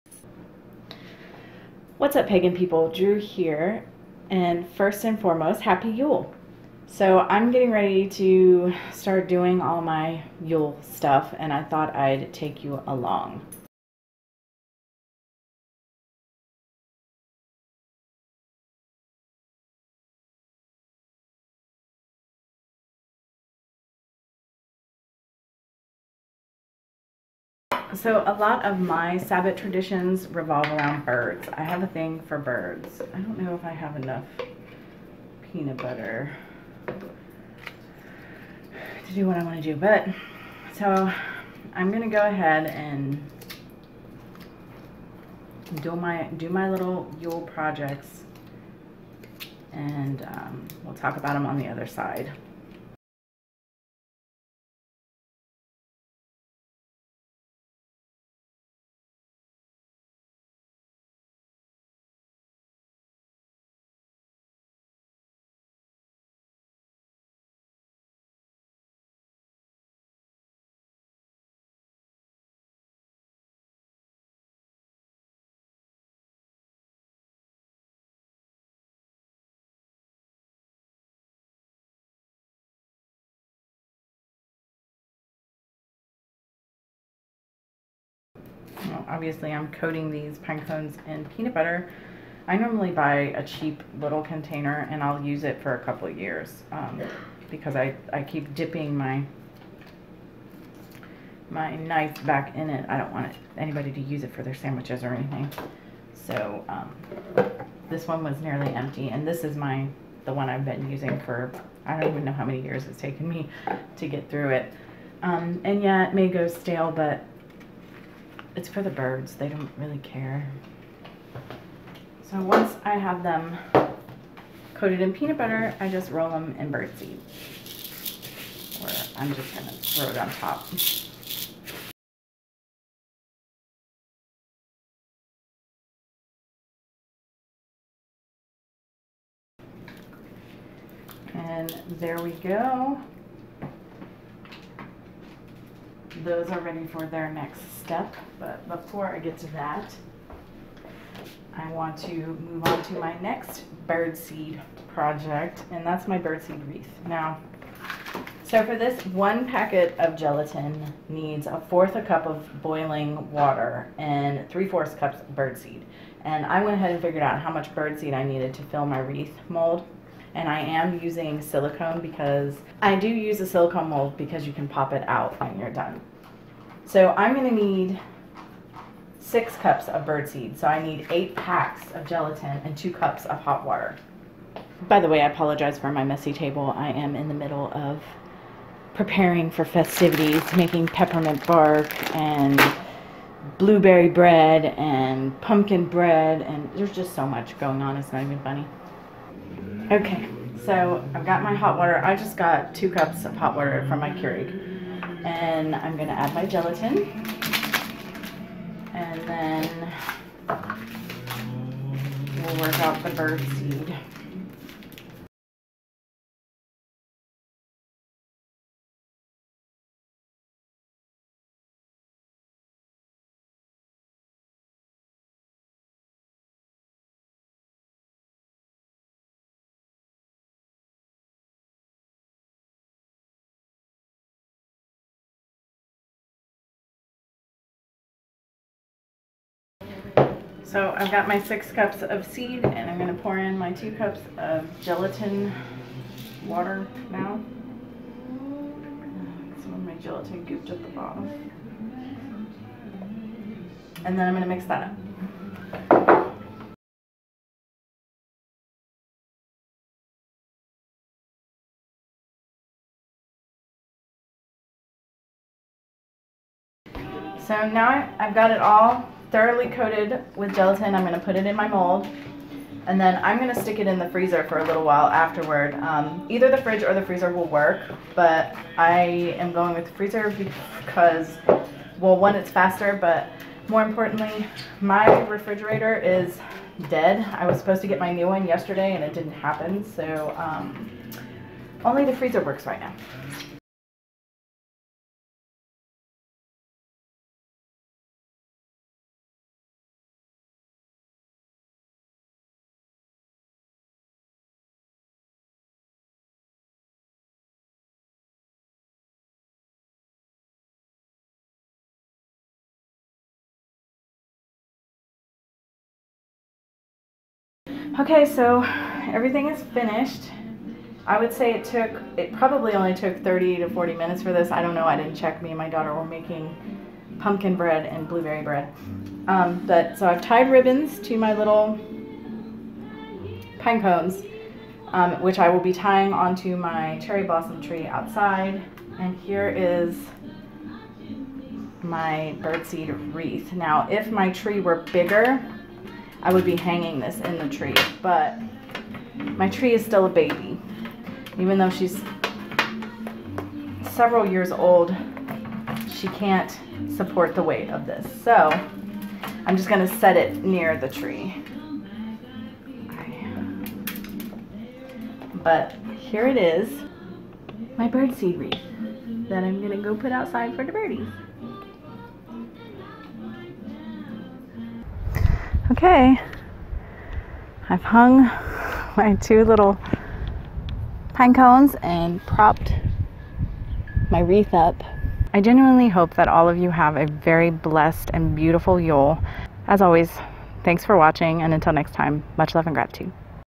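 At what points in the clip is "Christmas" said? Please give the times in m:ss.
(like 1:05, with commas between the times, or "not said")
not said.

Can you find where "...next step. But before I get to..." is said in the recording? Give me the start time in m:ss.
2:27.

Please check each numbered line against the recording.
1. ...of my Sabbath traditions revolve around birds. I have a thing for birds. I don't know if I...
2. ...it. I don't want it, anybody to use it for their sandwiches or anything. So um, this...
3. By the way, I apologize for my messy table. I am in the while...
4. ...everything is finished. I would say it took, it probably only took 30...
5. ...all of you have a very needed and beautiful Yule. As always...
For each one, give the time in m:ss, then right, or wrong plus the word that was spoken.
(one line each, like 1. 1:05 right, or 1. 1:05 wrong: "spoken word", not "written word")
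1. 0:28 right
2. 1:42 right
3. 3:04 wrong: "middle", not "while"
4. 5:19 right
5. 6:26 wrong: "blessed", not "needed".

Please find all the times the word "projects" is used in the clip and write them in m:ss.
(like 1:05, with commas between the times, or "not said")
0:47, 2:34.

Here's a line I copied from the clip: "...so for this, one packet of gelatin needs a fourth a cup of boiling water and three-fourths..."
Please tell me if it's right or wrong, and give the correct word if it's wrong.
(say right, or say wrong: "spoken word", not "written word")
right.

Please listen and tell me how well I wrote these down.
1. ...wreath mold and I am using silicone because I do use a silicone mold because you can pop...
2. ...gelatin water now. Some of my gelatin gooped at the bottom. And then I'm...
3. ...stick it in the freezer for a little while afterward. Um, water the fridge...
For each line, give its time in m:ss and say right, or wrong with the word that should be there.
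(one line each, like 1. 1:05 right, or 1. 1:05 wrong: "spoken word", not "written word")
1. 2:48 right
2. 4:04 right
3. 4:33 wrong: "either", not "water".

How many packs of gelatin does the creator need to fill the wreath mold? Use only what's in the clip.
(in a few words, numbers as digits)
8.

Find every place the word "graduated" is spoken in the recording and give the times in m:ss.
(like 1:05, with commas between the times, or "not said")
not said.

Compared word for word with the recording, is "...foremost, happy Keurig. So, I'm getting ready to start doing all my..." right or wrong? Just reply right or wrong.
wrong.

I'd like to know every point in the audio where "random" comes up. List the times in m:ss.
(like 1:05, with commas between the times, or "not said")
not said.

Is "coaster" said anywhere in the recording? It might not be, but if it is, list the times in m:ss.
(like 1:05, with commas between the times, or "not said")
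not said.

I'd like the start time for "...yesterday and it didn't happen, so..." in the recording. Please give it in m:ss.
4:48.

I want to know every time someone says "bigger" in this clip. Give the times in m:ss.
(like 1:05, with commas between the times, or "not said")
5:44.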